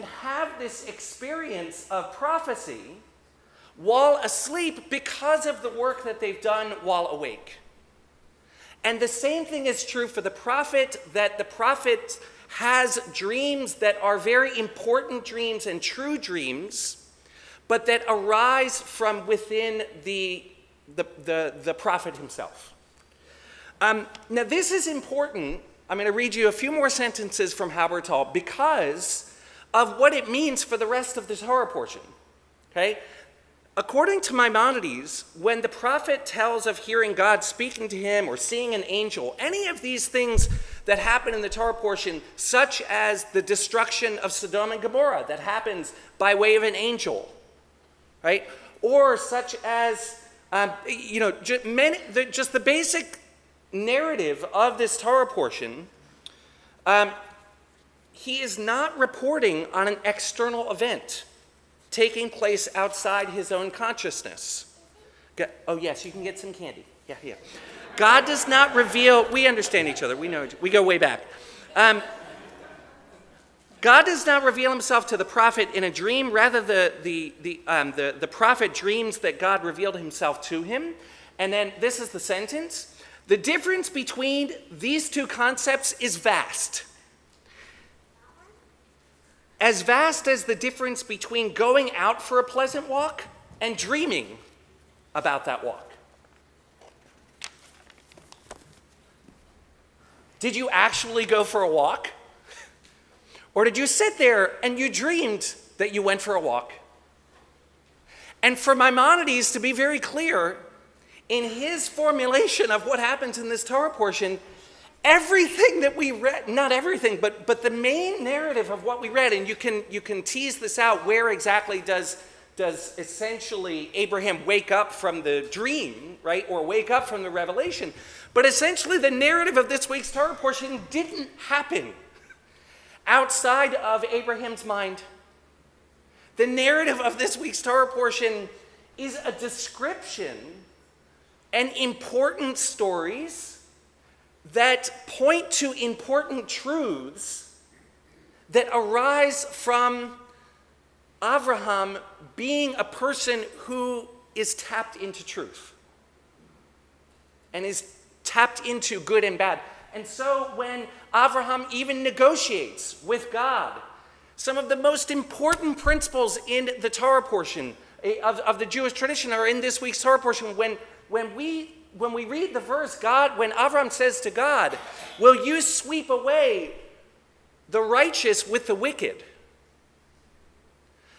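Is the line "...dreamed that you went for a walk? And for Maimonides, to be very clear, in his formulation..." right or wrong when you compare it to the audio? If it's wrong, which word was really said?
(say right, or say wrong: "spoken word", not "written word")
right.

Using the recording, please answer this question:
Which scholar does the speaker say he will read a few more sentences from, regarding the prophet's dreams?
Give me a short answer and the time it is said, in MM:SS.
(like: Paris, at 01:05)
Halbertal, at 00:27.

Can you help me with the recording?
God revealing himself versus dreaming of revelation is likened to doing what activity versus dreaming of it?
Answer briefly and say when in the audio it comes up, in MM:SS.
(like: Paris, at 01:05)
a pleasant walk, at 01:32.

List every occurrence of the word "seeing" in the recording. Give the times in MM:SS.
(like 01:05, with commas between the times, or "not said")
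00:38.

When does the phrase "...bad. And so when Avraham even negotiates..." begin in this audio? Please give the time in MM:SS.
02:39.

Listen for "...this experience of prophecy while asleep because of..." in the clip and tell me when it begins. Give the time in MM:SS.
00:00.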